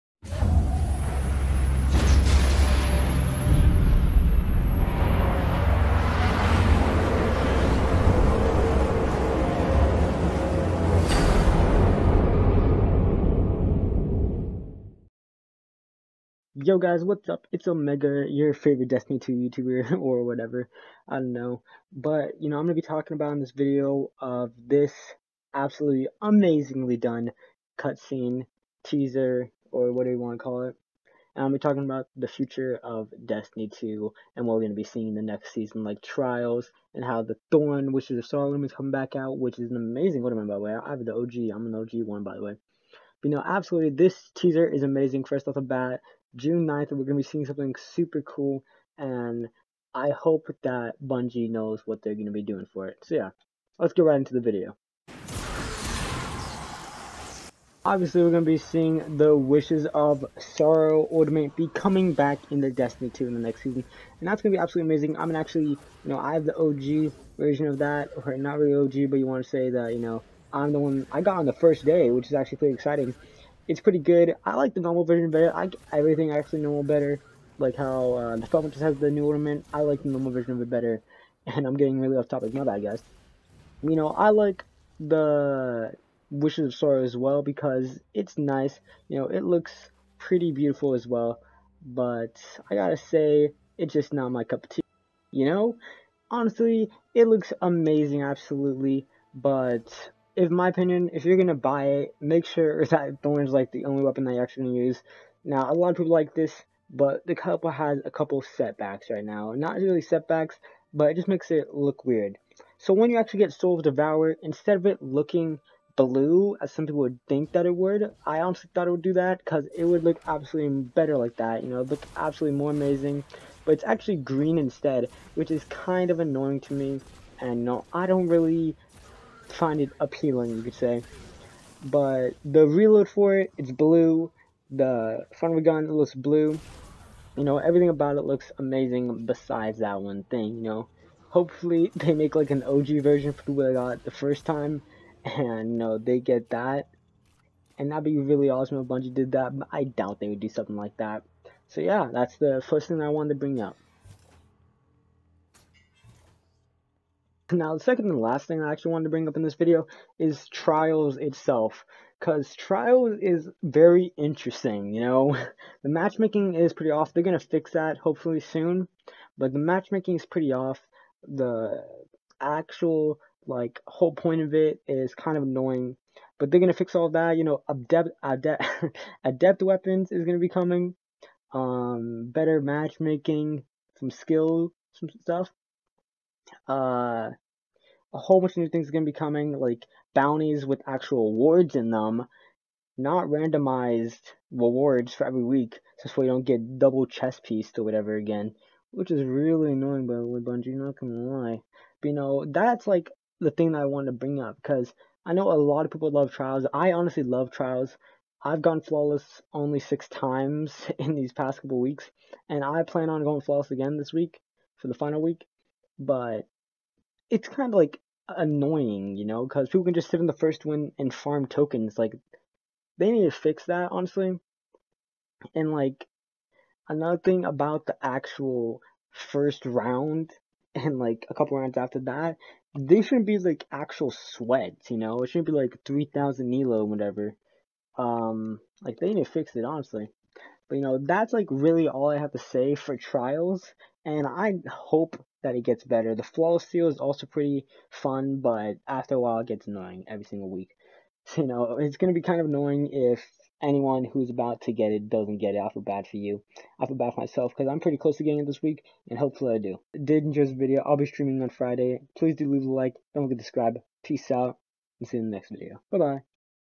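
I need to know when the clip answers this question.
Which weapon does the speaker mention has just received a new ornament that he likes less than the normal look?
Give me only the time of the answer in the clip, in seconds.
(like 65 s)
78 s.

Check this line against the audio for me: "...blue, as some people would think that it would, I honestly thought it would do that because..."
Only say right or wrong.
right.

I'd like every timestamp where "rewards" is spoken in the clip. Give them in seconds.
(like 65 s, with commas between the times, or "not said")
194 s.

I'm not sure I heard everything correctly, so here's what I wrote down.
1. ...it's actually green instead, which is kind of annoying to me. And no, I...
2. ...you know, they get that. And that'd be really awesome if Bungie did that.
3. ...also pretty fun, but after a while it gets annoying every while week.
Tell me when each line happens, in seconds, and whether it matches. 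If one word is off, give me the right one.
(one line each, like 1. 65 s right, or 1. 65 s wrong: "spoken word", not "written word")
1. 123 s right
2. 145 s right
3. 246 s wrong: "single", not "while".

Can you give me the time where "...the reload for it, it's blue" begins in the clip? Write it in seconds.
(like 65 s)
132 s.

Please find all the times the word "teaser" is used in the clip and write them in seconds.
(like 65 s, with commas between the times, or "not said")
28 s, 44 s.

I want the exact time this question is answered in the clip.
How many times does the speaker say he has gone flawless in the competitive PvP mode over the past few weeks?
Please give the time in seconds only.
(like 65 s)
209 s.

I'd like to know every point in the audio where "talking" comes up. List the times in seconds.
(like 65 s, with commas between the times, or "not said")
22 s, 31 s.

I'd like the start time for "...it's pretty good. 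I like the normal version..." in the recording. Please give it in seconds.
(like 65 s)
73 s.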